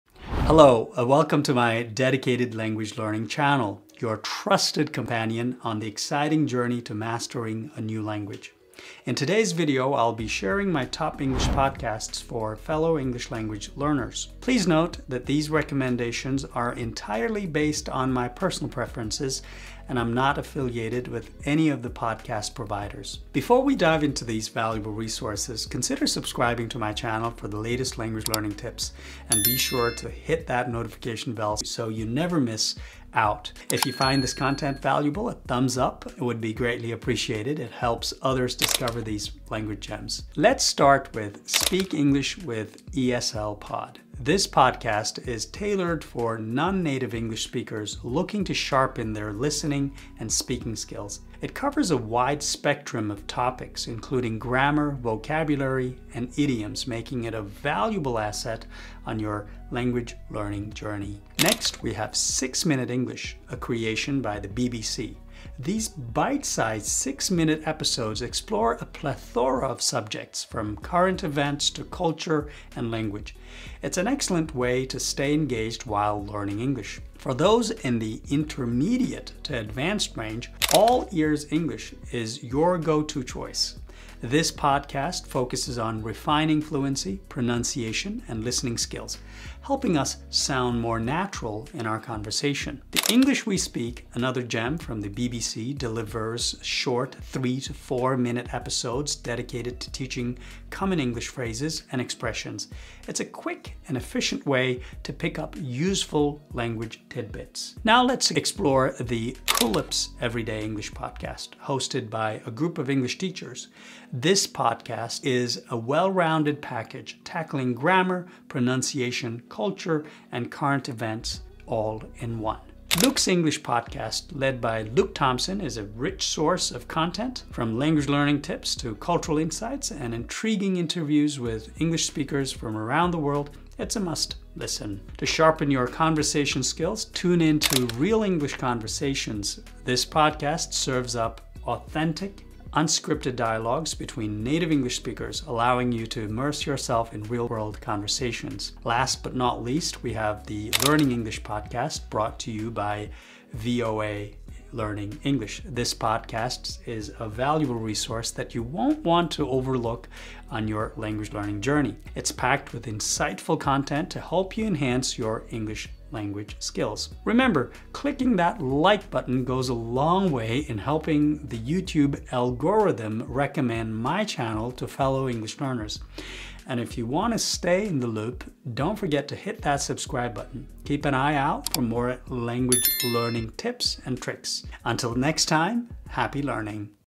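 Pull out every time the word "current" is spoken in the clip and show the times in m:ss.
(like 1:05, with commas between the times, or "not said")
1:10, 2:00.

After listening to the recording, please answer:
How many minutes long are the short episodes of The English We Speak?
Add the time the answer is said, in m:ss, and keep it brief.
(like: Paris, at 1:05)
3 to 4 minutes, at 1:37.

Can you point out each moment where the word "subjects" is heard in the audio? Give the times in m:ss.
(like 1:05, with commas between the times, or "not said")
1:09.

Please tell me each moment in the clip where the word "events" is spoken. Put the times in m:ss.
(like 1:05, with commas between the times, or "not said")
1:11, 2:00.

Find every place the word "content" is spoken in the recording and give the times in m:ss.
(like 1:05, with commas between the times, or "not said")
0:34, 2:06, 2:43.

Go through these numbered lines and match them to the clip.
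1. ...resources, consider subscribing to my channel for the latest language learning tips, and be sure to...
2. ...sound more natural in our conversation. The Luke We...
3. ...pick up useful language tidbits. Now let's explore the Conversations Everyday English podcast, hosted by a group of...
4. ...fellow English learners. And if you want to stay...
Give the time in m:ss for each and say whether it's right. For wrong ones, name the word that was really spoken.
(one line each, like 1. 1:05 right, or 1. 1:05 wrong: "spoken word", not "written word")
1. 0:24 right
2. 1:30 wrong: "English", not "Luke"
3. 1:45 wrong: "Culips", not "Conversations"
4. 2:54 right.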